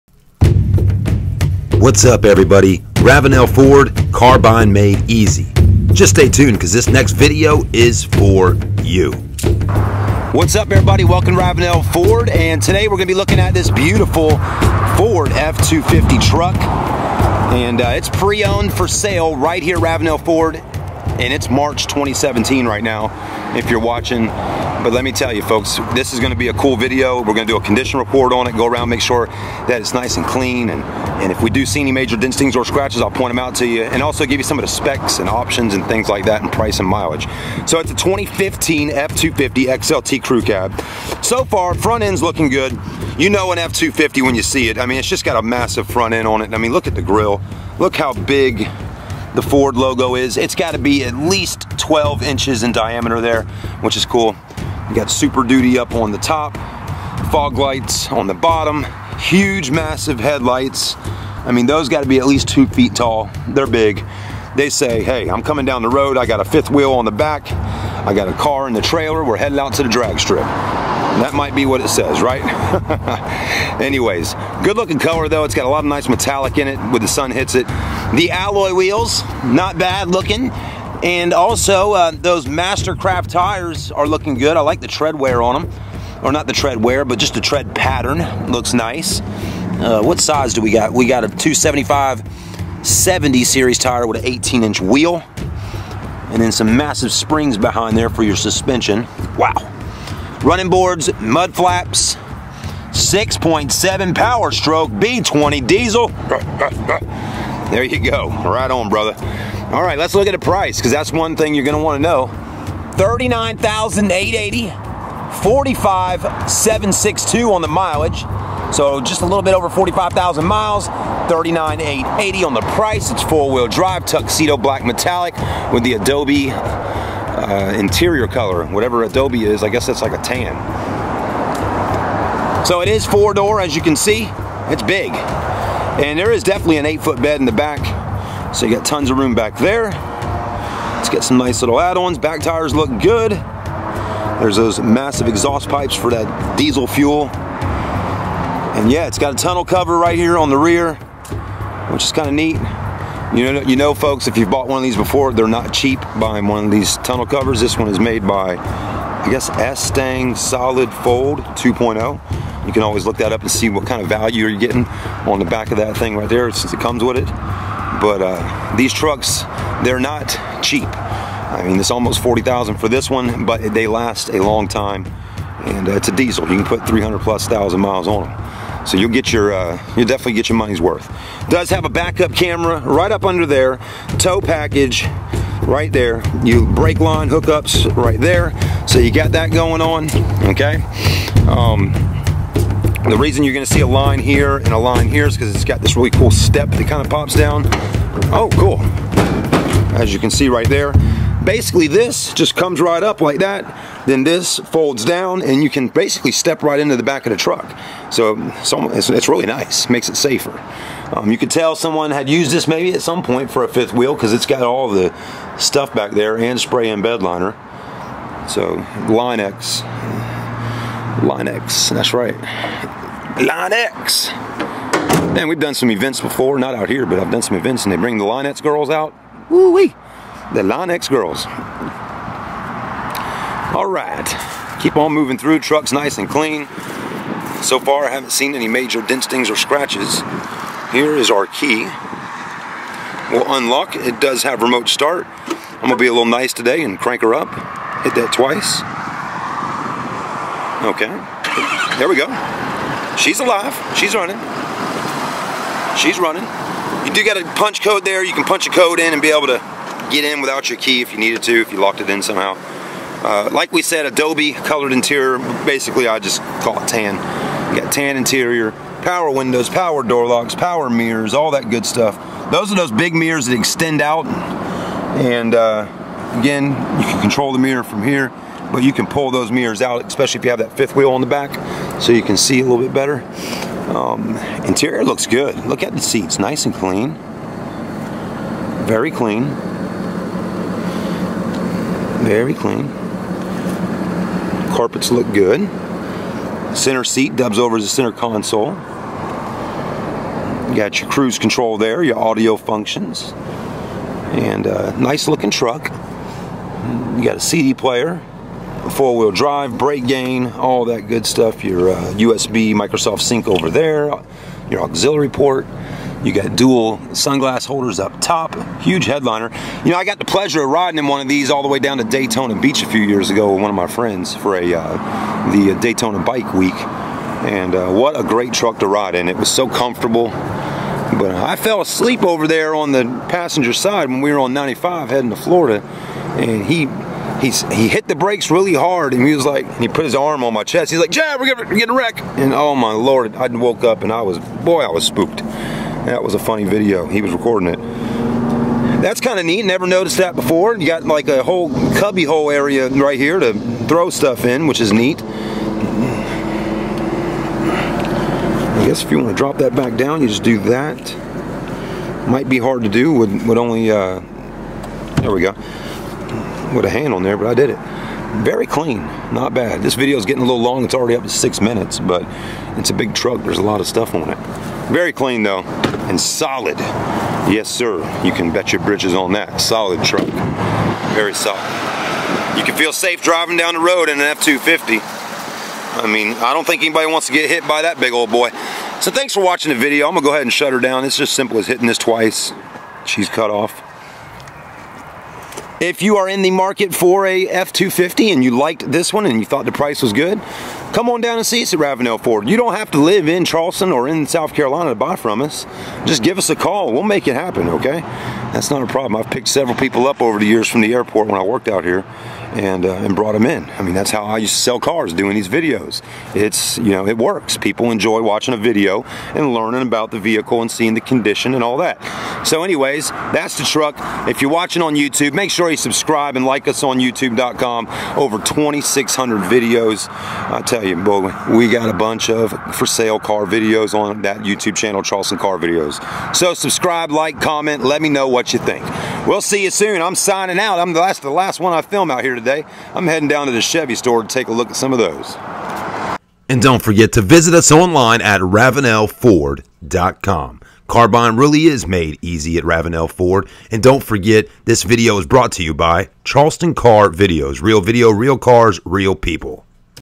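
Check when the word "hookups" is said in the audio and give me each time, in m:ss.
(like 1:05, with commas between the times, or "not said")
3:07.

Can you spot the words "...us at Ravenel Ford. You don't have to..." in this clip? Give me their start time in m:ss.
6:41.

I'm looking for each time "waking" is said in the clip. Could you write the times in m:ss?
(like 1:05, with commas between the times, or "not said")
not said.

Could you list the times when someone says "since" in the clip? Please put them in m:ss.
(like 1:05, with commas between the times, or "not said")
2:46.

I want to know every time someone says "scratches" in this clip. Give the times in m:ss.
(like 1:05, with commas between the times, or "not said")
0:32, 3:59.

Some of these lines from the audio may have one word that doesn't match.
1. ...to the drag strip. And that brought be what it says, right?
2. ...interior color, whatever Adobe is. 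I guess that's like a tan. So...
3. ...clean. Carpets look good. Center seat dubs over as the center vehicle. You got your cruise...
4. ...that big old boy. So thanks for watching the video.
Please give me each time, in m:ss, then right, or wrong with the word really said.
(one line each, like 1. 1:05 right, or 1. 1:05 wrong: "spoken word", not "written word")
1. 1:09 wrong: "might", not "brought"
2. 2:07 right
3. 4:52 wrong: "console", not "vehicle"
4. 6:27 right.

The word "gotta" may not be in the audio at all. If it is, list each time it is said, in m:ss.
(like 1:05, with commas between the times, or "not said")
0:50, 1:01.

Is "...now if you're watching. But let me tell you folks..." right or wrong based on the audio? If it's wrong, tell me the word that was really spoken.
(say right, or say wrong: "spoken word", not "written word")
right.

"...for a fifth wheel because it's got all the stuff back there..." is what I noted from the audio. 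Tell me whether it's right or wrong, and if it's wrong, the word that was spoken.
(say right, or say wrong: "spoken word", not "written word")
right.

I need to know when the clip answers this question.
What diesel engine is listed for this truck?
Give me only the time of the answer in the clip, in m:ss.
1:43.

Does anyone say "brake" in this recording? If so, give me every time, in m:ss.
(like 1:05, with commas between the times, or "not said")
3:06, 5:09, 5:38.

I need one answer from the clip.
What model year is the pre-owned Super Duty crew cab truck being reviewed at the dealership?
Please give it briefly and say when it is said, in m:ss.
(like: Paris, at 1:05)
2015, at 0:37.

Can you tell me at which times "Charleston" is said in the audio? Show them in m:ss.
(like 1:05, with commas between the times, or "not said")
6:43, 7:15, 7:36.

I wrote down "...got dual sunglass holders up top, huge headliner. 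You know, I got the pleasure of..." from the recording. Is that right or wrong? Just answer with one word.
right.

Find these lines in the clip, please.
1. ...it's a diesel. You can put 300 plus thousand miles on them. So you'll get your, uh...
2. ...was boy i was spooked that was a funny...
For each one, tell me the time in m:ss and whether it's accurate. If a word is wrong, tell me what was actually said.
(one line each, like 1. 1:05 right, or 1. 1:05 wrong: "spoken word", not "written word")
1. 2:55 right
2. 5:44 right.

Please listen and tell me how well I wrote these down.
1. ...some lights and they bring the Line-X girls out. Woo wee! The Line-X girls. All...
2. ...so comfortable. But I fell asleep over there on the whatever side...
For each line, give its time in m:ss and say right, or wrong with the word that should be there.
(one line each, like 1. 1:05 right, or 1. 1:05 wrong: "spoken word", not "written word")
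1. 3:47 wrong: "events", not "lights"
2. 5:29 wrong: "passenger", not "whatever".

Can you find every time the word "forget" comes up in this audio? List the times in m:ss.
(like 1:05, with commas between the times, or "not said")
7:26, 7:34.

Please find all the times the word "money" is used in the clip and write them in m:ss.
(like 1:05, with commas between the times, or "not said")
3:00.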